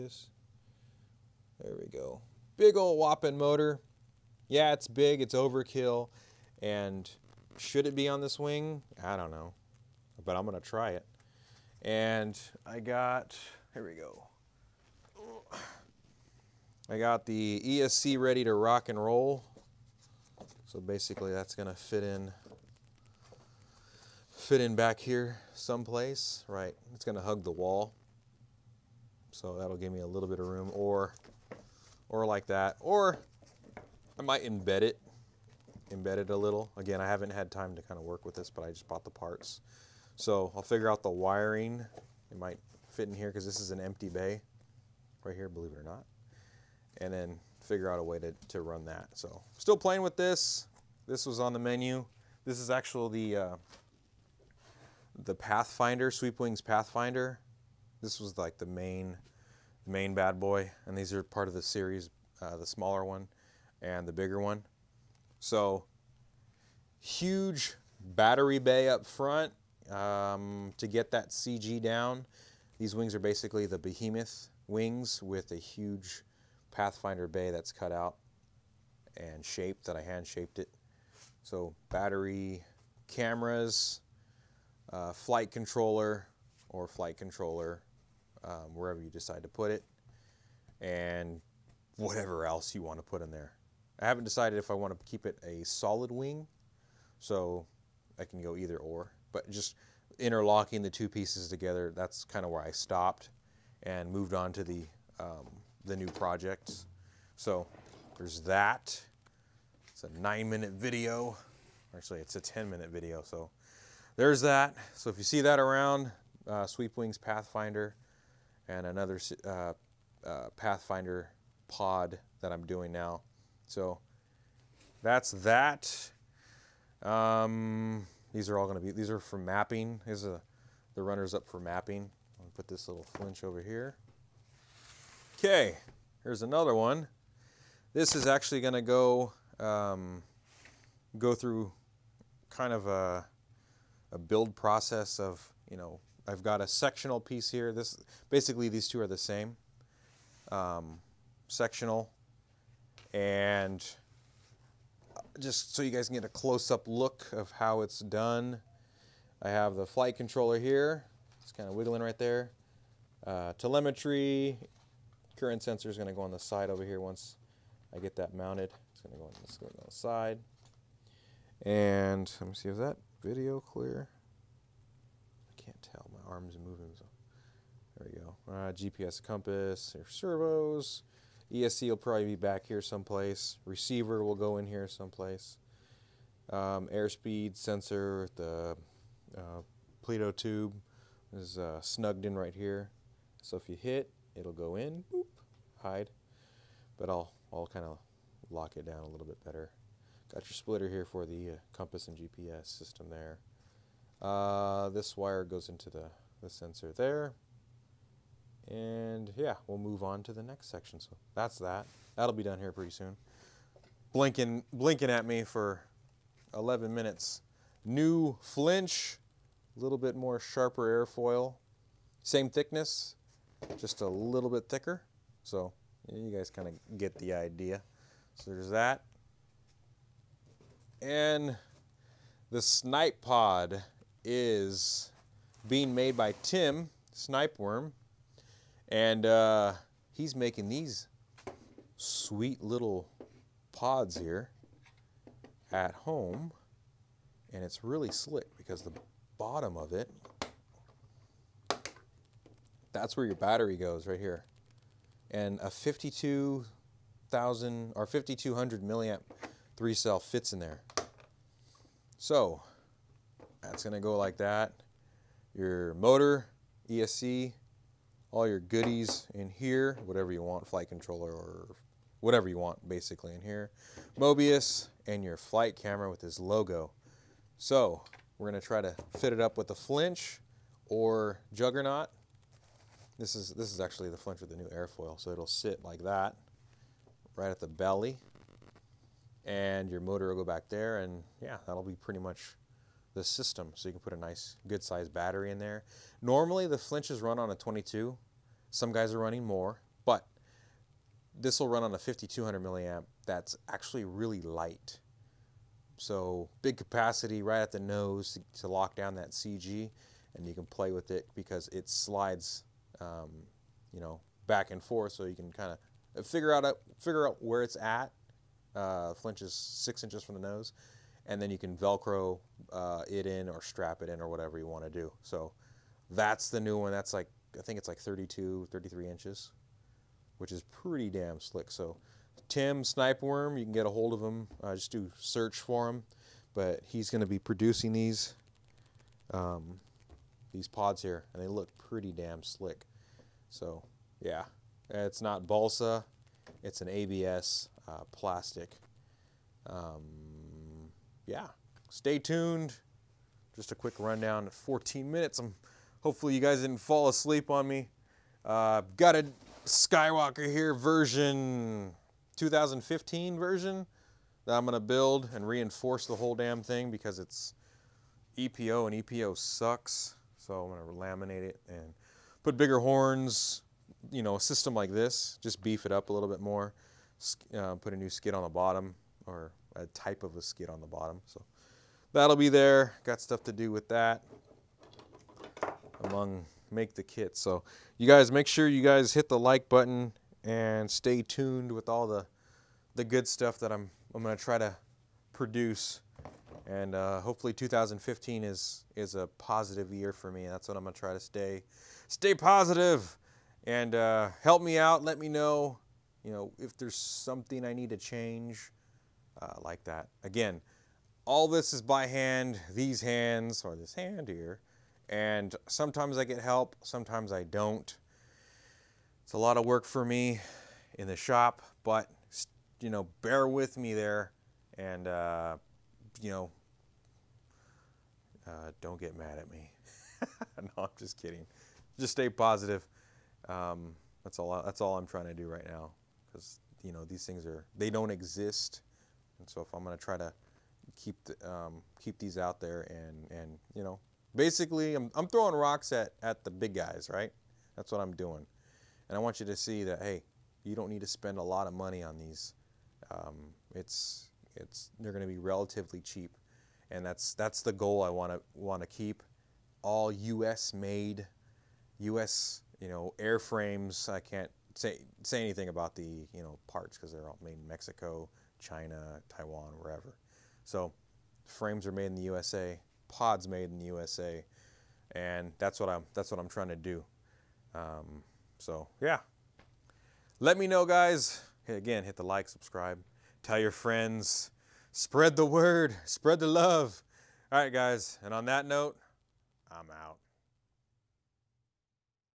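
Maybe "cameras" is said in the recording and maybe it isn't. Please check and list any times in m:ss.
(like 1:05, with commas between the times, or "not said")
1:23, 4:35.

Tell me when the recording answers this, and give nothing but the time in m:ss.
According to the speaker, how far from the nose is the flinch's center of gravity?
5:19.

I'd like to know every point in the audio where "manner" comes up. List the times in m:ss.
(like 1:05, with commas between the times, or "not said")
not said.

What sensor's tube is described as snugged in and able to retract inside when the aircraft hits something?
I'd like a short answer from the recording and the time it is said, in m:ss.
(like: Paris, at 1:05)
airspeed sensor, at 3:06.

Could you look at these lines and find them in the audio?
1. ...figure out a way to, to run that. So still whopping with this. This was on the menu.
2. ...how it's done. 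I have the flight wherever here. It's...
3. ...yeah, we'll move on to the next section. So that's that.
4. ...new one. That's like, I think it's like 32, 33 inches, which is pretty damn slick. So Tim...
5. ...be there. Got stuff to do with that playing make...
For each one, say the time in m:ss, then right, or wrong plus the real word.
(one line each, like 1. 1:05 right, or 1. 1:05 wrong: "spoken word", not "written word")
1. 0:47 wrong: "playing", not "whopping"
2. 2:37 wrong: "controller", not "wherever"
3. 3:29 right
4. 5:26 right
5. 6:22 wrong: "among", not "playing".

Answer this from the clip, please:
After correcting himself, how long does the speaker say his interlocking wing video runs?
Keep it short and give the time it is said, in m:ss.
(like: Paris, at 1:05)
10 minutes, at 1:52.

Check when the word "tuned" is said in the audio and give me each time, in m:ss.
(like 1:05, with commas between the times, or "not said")
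5:52, 6:31.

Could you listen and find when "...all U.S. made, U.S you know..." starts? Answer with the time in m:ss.
7:39.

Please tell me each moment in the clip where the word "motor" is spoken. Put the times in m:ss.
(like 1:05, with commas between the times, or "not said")
0:03, 4:25, 4:50.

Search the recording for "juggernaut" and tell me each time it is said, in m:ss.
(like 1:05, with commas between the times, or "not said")
4:41.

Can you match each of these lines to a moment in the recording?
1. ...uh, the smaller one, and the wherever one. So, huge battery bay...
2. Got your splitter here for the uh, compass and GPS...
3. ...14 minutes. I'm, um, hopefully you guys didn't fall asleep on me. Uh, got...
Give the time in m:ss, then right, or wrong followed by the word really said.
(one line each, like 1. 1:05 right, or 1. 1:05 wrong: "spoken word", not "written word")
1. 1:02 wrong: "bigger", not "wherever"
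2. 3:20 right
3. 5:54 right.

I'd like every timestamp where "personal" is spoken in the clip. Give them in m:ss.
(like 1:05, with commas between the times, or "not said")
not said.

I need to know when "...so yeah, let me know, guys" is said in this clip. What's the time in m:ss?
7:58.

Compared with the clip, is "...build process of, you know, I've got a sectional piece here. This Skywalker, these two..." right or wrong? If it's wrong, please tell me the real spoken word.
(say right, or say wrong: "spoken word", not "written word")
wrong: "Basically", not "Skywalker".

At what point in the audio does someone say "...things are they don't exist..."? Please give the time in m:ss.
7:17.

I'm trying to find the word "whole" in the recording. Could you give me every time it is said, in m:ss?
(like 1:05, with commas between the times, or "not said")
6:06.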